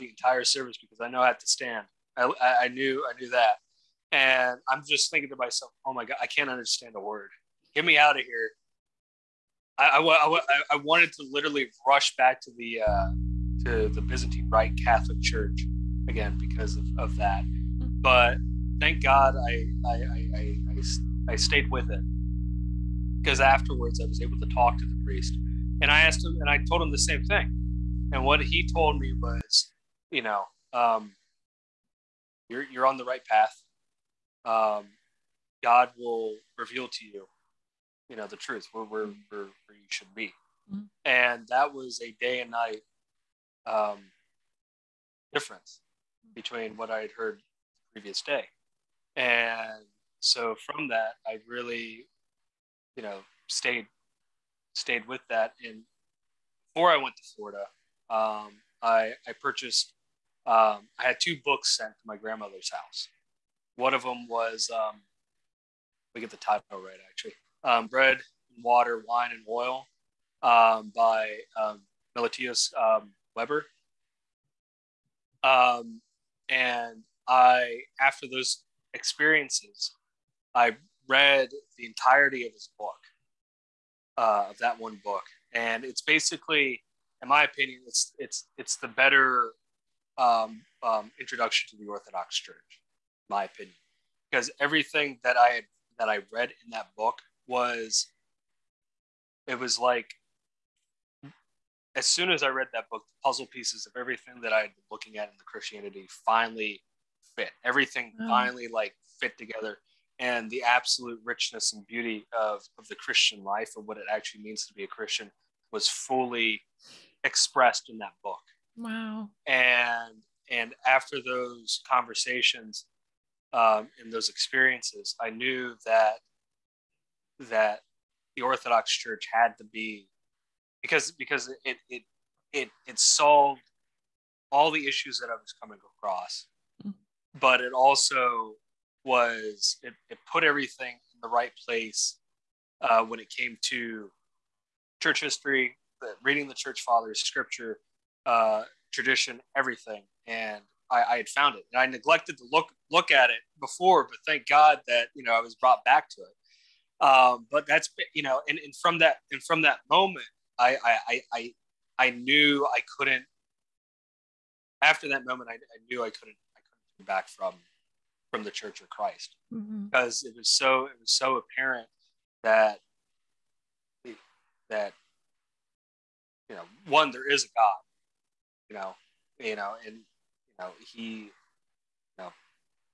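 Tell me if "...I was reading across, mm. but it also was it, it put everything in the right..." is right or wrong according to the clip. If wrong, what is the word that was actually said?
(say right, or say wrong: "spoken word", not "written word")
wrong: "coming", not "reading".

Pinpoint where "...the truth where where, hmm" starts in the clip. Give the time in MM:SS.
00:38.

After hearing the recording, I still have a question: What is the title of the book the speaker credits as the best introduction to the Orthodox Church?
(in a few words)
Bread, Water, Wine, and Oil.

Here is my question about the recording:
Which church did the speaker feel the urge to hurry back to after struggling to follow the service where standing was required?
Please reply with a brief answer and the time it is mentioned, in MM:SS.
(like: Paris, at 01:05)
Byzantine Rite Catholic Church, at 00:14.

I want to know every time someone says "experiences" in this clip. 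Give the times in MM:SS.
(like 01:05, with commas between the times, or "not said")
01:18, 02:04.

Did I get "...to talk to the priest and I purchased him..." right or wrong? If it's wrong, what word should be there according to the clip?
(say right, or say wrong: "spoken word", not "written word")
wrong: "asked", not "purchased".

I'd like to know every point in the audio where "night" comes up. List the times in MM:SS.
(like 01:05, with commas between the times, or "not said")
00:42.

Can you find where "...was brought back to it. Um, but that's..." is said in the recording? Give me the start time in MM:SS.
02:35.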